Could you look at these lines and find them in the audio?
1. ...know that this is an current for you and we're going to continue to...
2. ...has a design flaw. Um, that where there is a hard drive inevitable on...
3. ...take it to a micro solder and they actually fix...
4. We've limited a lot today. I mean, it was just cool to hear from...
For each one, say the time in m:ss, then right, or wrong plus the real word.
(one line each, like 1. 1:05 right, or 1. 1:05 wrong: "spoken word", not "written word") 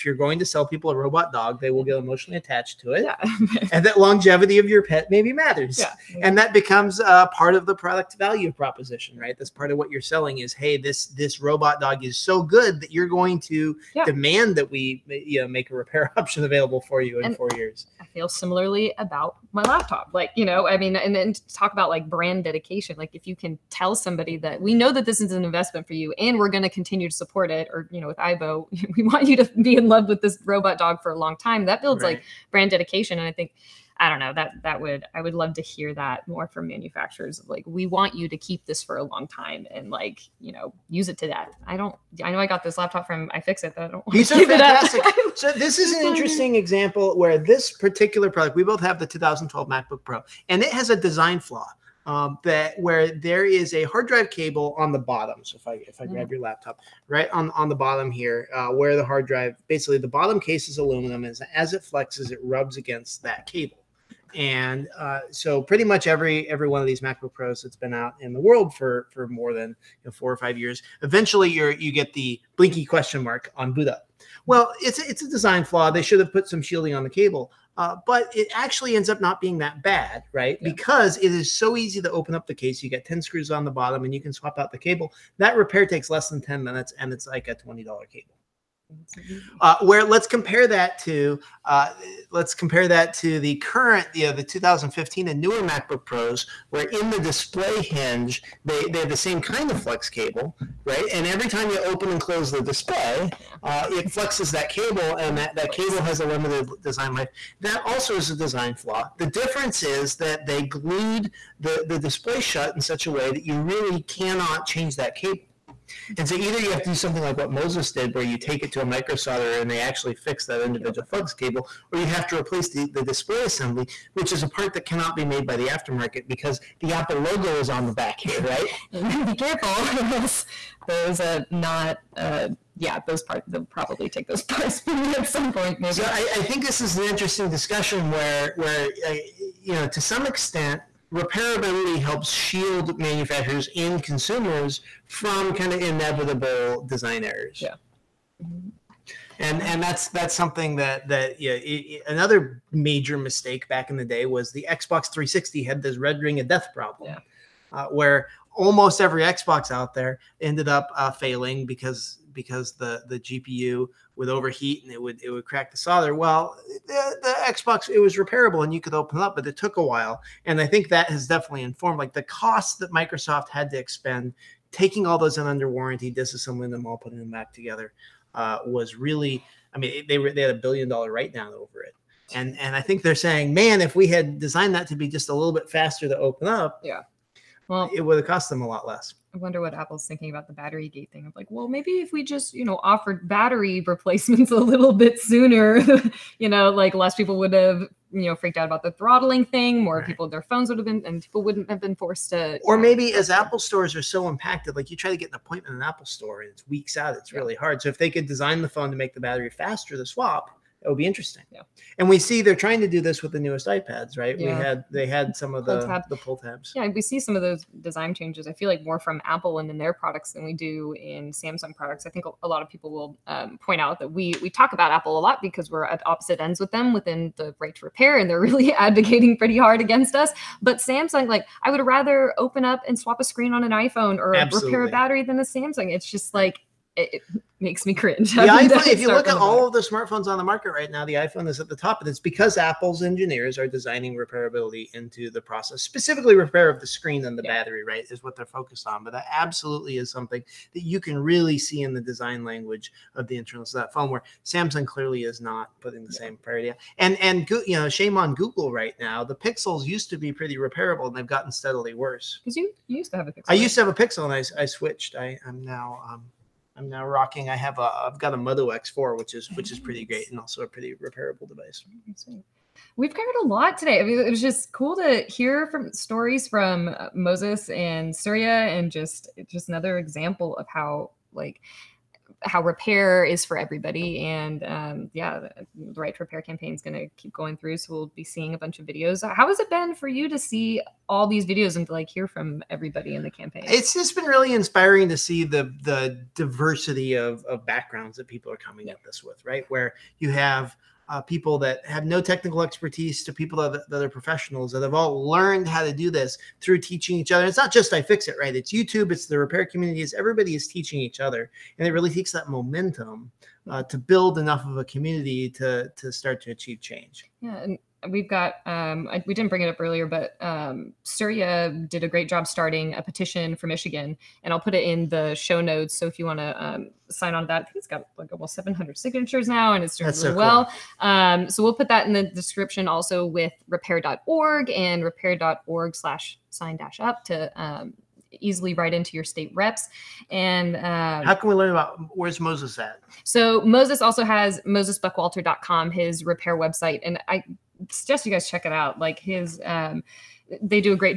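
1. 0:24 wrong: "investment", not "current"
2. 0:50 wrong: "cable", not "inevitable"
3. 1:58 right
4. 4:32 wrong: "covered", not "limited".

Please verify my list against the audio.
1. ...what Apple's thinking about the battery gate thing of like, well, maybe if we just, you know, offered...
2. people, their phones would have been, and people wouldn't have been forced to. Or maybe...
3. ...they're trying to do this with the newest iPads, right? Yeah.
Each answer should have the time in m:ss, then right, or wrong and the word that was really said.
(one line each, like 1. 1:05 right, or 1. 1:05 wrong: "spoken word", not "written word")
1. 3:09 right
2. 3:20 right
3. 3:32 right.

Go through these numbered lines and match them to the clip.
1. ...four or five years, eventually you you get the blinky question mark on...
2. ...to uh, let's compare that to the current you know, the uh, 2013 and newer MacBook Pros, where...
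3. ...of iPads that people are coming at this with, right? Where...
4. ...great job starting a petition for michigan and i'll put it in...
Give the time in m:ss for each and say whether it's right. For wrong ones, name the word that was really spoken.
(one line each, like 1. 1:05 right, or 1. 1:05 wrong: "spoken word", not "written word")
1. 1:10 right
2. 1:30 wrong: "2015", not "2013"
3. 4:57 wrong: "backgrounds", not "iPads"
4. 5:22 right.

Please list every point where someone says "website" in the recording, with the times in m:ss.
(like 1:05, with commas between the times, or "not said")
5:46.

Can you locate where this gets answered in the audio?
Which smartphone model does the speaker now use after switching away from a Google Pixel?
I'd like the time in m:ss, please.
4:28.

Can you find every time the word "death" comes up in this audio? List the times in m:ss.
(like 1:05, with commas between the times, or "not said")
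0:41, 2:36.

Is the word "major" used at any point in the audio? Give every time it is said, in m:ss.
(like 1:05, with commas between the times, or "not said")
2:32.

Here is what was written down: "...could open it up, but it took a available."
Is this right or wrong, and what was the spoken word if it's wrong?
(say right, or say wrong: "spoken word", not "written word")
wrong: "while", not "available".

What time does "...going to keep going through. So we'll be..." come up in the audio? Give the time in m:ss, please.
4:46.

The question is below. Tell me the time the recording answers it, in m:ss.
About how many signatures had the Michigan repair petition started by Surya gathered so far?
5:28.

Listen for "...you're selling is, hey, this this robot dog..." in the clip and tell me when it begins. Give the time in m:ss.
0:09.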